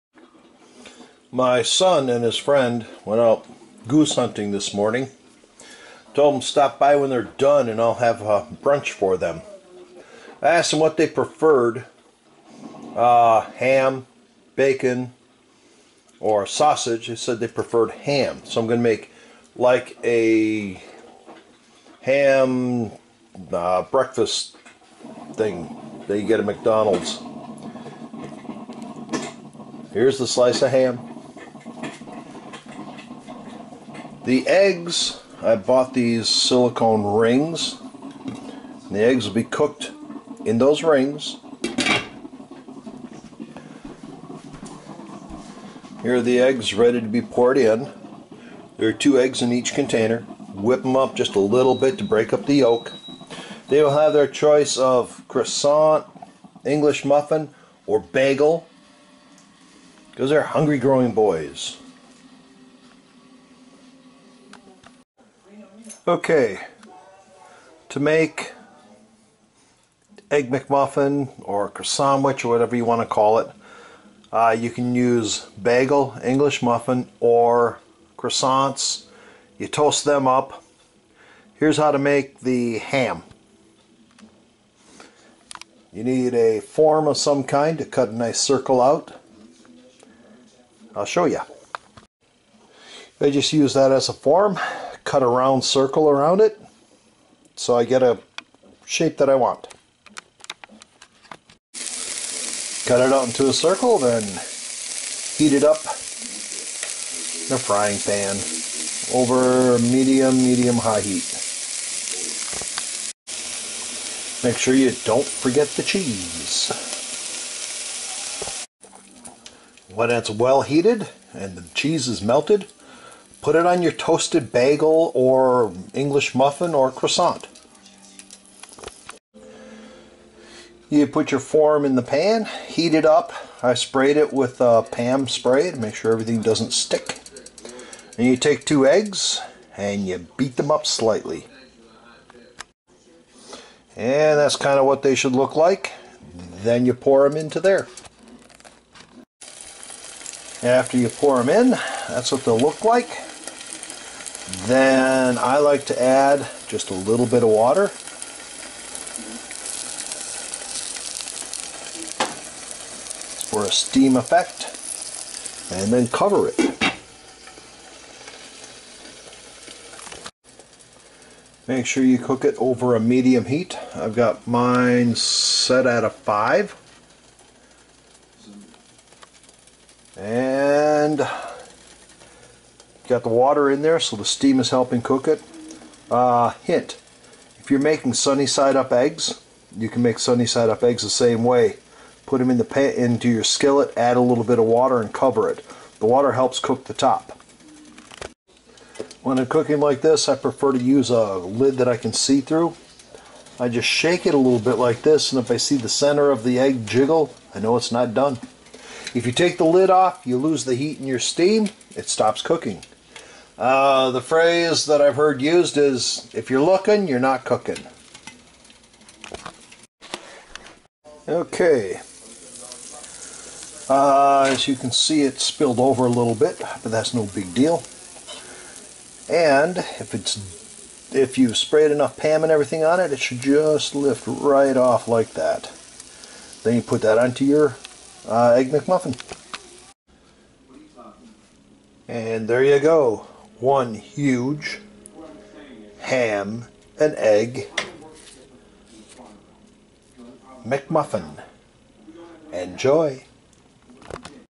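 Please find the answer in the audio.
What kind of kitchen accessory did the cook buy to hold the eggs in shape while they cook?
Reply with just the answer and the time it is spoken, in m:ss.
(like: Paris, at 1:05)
Silicone rings, at 0:36.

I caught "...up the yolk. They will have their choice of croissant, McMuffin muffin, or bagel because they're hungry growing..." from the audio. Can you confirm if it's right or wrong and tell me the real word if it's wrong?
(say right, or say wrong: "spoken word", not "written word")
wrong: "English", not "McMuffin".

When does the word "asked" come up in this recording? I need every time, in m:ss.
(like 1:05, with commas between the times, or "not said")
0:10.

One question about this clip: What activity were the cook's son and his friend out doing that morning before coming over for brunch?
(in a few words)
Goose hunting.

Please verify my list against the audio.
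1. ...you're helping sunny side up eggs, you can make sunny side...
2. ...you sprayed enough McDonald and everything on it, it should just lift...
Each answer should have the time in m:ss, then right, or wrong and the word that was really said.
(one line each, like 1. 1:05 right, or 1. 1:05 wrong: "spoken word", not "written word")
1. 3:07 wrong: "making", not "helping"
2. 3:51 wrong: "PAM", not "McDonald".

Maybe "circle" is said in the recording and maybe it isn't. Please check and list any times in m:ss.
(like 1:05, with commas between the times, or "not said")
1:28, 1:35, 1:43.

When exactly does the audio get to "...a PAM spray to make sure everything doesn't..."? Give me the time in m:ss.
2:14.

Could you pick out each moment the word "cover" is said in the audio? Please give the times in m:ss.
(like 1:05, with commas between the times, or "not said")
2:46, 3:15.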